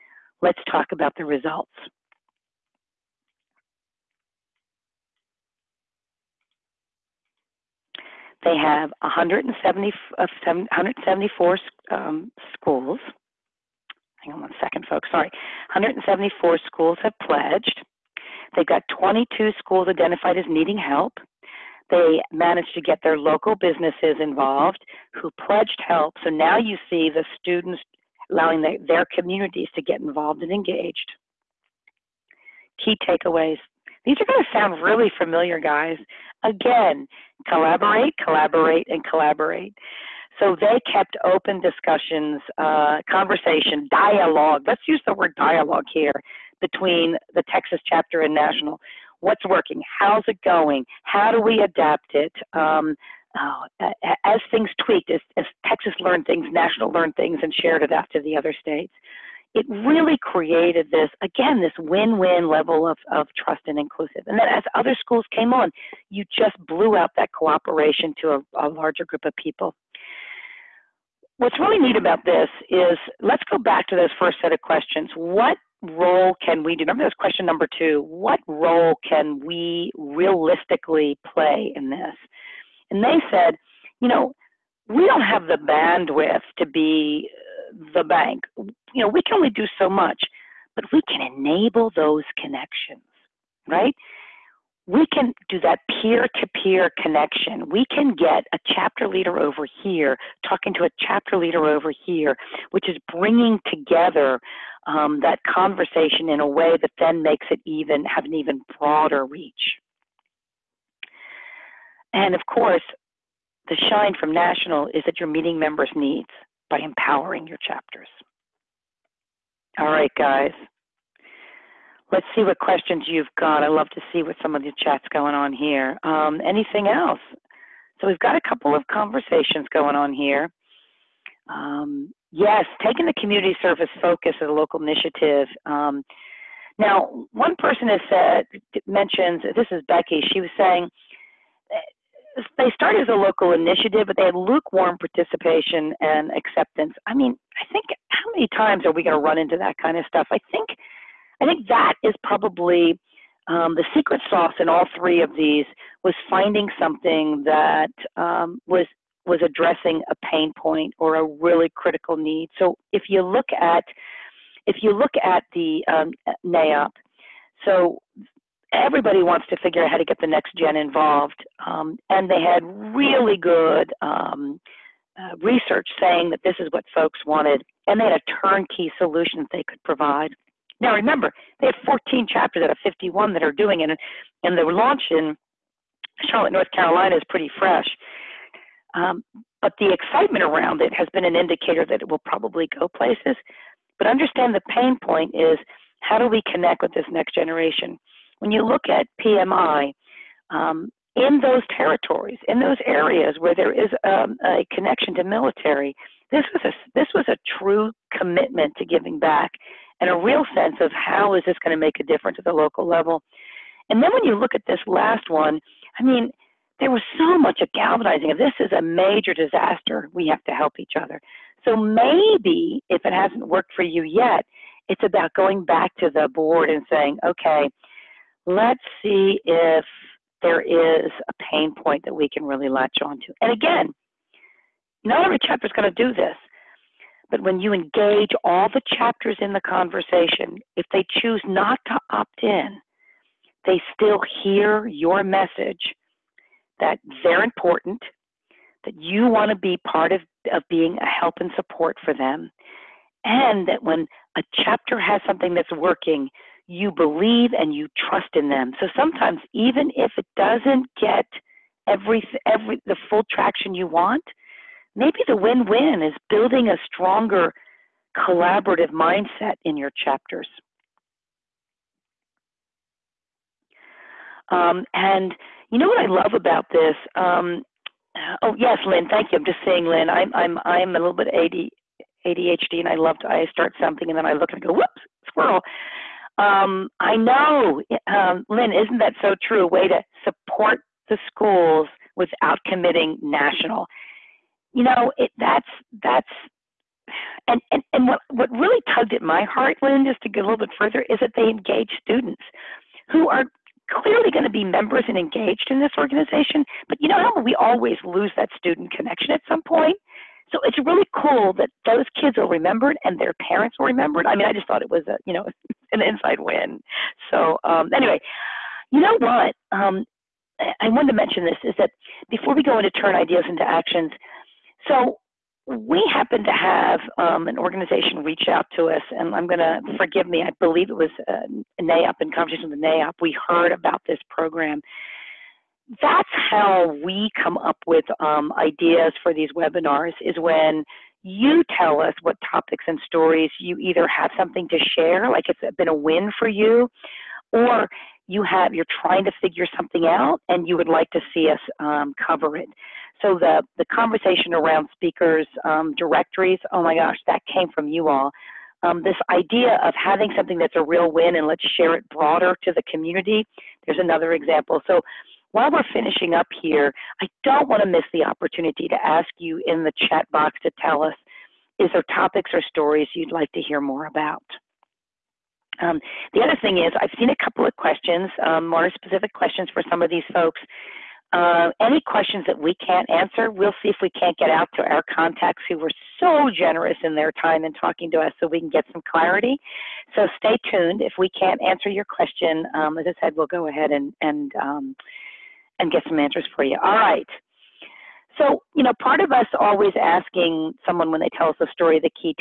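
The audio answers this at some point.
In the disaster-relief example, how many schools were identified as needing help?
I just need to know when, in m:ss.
0:18.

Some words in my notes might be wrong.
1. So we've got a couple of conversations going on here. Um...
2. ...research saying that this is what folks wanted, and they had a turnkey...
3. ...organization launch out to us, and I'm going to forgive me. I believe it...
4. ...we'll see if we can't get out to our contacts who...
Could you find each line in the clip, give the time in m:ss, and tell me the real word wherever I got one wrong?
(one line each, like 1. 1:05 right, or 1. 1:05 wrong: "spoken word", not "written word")
1. 2:07 right
2. 2:55 right
3. 5:27 wrong: "reach", not "launch"
4. 6:23 right.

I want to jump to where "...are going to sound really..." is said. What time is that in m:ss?
0:34.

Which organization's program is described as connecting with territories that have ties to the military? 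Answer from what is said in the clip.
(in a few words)
PMI.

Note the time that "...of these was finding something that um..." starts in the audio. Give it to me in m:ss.
2:35.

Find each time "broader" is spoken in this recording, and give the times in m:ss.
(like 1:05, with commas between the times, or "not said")
1:48, 6:02.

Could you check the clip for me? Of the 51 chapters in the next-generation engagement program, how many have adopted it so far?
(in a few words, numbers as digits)
14.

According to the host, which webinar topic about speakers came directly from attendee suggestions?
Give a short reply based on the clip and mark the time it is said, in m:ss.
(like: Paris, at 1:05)
Directories, at 5:55.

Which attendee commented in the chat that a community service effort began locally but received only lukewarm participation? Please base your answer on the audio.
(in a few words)
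Becky.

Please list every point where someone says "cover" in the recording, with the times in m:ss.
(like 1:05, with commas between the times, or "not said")
5:52.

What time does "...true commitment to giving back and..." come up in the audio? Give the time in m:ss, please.
3:27.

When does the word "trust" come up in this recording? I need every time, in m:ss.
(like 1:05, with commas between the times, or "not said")
1:03, 4:18.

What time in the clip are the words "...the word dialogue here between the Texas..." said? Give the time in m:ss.
0:45.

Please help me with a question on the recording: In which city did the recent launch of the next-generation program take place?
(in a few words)
Charlotte, North Carolina.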